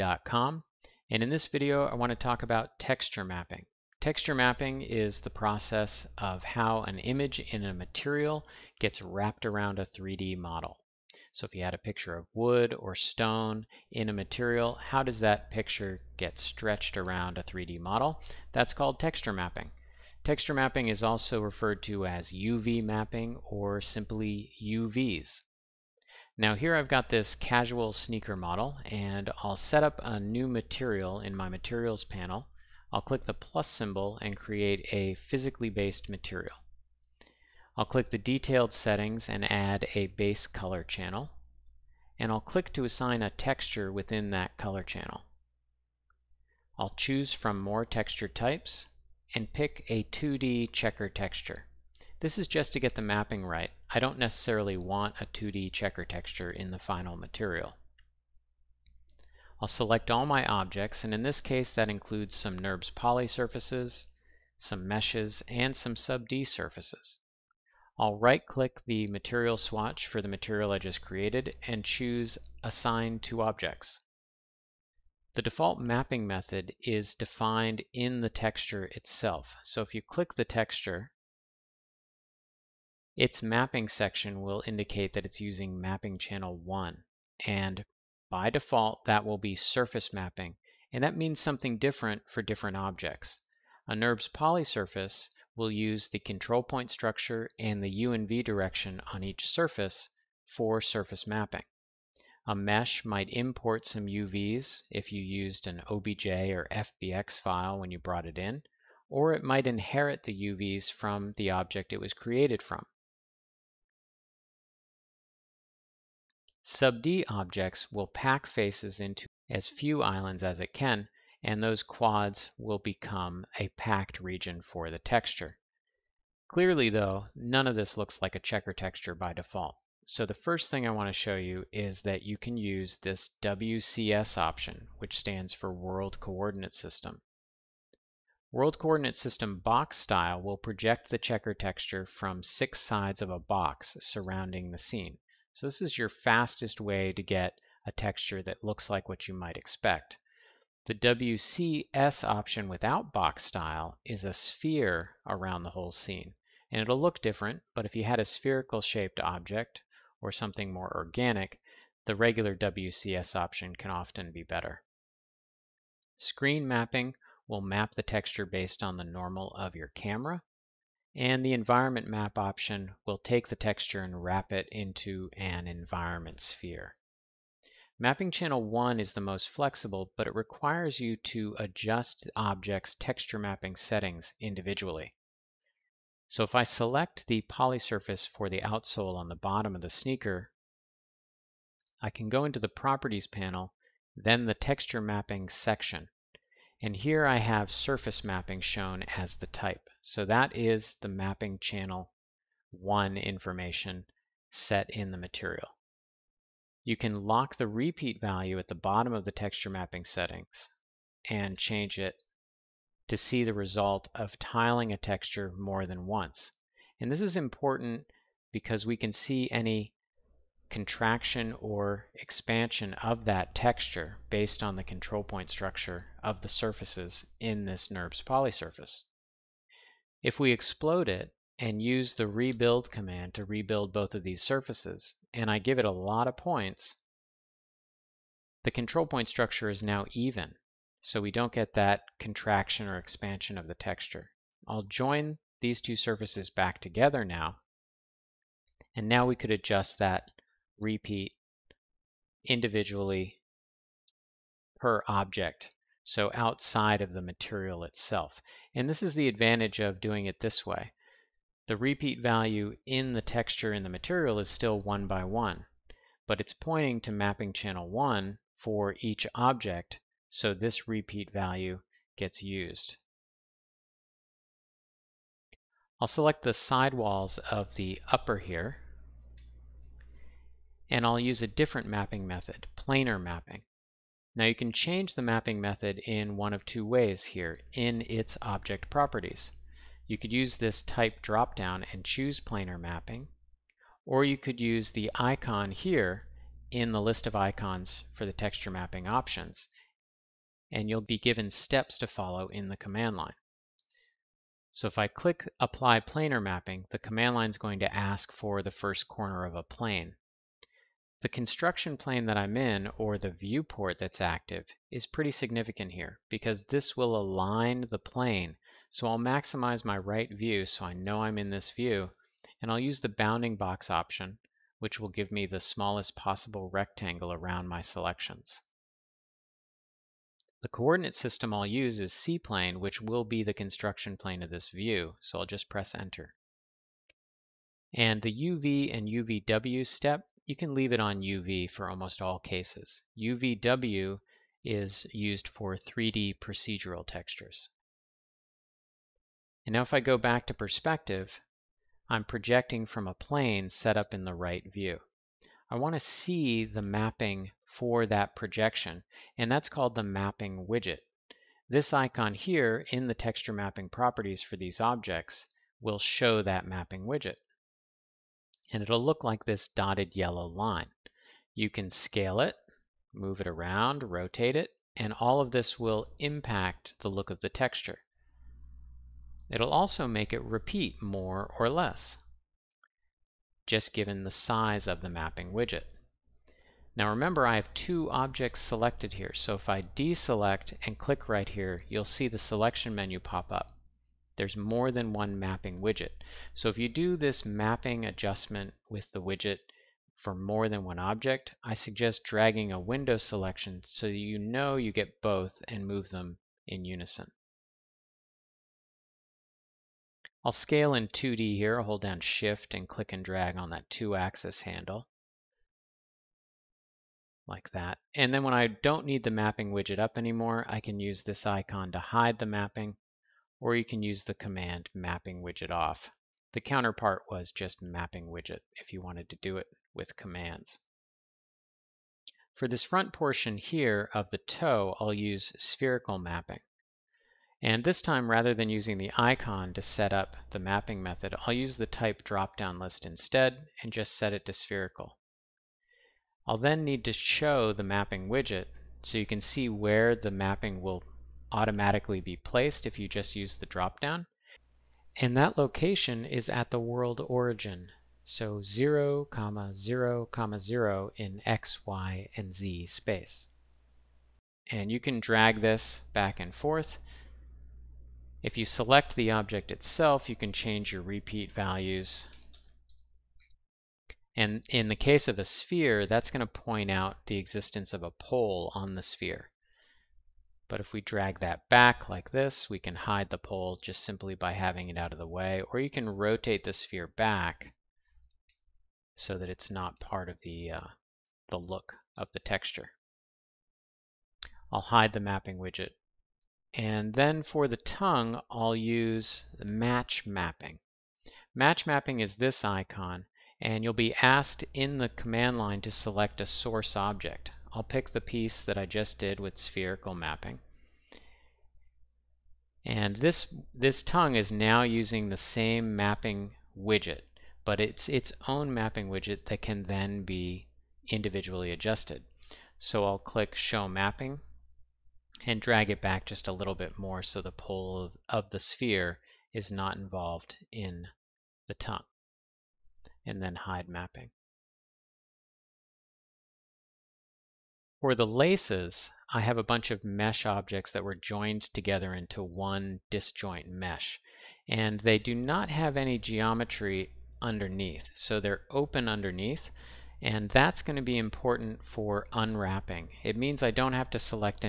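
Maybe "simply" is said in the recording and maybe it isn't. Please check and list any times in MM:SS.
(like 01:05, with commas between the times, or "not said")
00:23, 08:04.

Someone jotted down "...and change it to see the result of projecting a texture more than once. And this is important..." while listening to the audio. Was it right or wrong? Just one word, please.
wrong.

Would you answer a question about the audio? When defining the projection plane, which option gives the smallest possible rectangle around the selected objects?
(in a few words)
bounding box.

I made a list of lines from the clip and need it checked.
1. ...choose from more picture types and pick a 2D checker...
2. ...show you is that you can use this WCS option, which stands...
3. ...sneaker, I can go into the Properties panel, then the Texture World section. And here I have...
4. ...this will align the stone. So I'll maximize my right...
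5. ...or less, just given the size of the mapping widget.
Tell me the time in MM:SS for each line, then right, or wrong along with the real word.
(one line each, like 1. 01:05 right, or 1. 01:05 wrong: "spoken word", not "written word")
1. 00:46 wrong: "texture", not "picture"
2. 02:11 right
3. 03:09 wrong: "Mapping", not "World"
4. 05:16 wrong: "plane", not "stone"
5. 06:21 right.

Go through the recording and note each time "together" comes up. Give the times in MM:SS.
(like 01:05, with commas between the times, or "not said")
04:06, 09:01.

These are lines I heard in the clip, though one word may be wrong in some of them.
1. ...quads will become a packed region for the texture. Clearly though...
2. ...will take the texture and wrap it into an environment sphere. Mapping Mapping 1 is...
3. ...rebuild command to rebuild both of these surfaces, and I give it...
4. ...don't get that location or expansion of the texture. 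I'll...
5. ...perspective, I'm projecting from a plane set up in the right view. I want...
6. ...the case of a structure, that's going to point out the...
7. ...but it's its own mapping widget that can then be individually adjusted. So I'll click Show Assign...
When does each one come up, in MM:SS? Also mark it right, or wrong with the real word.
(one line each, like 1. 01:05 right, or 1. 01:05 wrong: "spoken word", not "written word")
1. 02:01 right
2. 02:53 wrong: "Channel", not "Mapping"
3. 03:52 right
4. 04:01 wrong: "contraction", not "location"
5. 05:50 right
6. 07:54 wrong: "sphere", not "structure"
7. 08:37 wrong: "Mapping", not "Assign".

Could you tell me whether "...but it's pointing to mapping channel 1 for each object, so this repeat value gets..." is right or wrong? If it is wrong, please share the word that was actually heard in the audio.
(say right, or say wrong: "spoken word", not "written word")
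right.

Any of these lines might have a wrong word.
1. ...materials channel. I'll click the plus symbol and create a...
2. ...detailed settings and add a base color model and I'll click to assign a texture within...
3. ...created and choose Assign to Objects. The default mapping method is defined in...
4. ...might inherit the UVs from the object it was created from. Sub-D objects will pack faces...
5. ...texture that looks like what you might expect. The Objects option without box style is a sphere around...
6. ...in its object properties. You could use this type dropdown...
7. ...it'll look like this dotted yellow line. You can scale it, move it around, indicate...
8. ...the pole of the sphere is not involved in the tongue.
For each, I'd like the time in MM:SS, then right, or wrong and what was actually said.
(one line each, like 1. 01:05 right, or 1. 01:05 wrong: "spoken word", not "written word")
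1. 00:31 wrong: "panel", not "channel"
2. 00:38 wrong: "channel", not "model"
3. 01:11 right
4. 01:49 right
5. 02:27 wrong: "WCS", not "Objects"
6. 04:47 right
7. 06:08 wrong: "rotate", not "indicate"
8. 08:47 right.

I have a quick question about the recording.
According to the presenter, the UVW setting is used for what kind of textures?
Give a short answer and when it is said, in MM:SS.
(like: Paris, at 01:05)
3D procedural textures, at 05:45.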